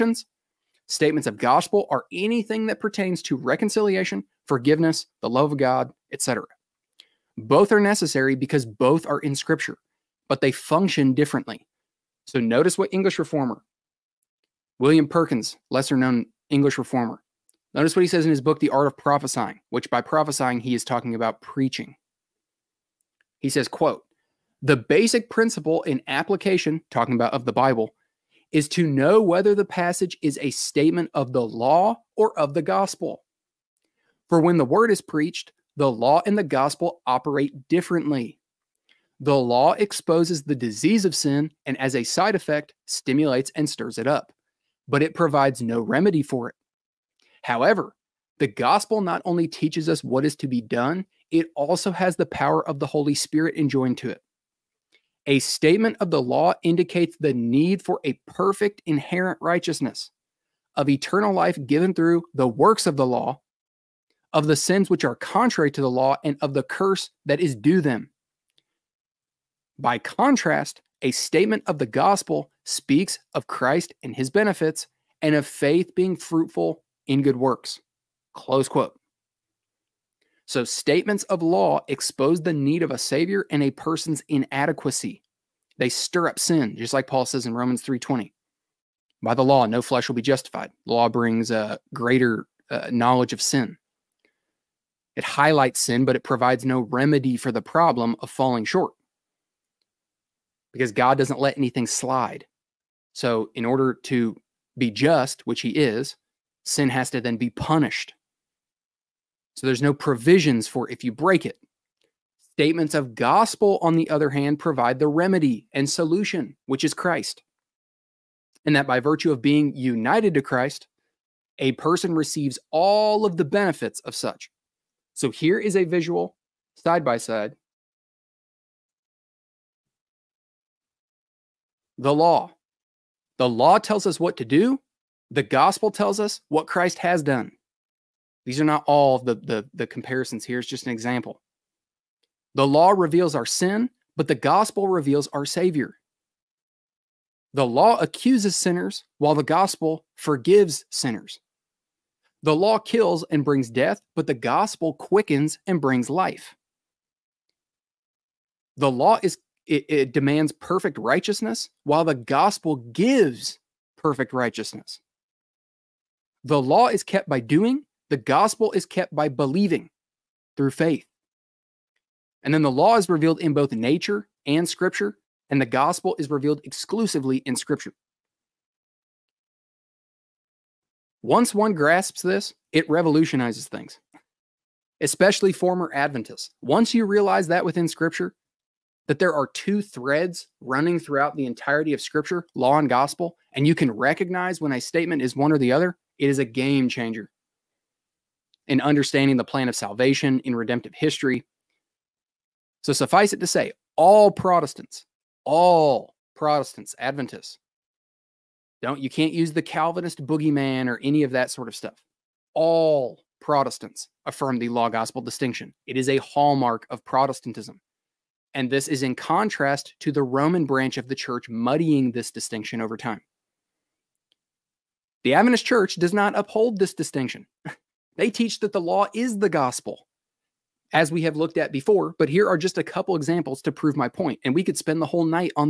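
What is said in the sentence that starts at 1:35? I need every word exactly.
It highlights sin, but it provides no remedy for the problem of falling short because God doesn't let anything slide.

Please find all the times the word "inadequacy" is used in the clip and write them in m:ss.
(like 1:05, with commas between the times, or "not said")
1:24.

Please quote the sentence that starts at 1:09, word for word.
By contrast, a statement of the gospel speaks of Christ and his benefits and of faith being fruitful in good works.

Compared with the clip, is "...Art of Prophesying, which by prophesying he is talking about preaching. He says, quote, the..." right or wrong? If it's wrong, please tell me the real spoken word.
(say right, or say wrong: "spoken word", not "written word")
right.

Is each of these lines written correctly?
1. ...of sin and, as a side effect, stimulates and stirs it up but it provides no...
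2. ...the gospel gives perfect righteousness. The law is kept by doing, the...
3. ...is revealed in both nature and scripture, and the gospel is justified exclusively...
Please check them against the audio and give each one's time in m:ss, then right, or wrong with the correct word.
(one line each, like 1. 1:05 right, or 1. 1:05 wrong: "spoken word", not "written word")
1. 0:41 right
2. 2:42 right
3. 2:52 wrong: "revealed", not "justified".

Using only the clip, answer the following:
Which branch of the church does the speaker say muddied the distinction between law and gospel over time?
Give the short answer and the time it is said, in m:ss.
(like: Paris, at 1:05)
The Roman branch, at 3:40.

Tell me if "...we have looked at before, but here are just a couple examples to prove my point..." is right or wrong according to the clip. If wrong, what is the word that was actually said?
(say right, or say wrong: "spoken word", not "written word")
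right.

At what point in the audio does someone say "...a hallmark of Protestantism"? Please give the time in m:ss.
3:36.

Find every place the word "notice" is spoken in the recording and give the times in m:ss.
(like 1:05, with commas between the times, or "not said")
0:12, 0:17.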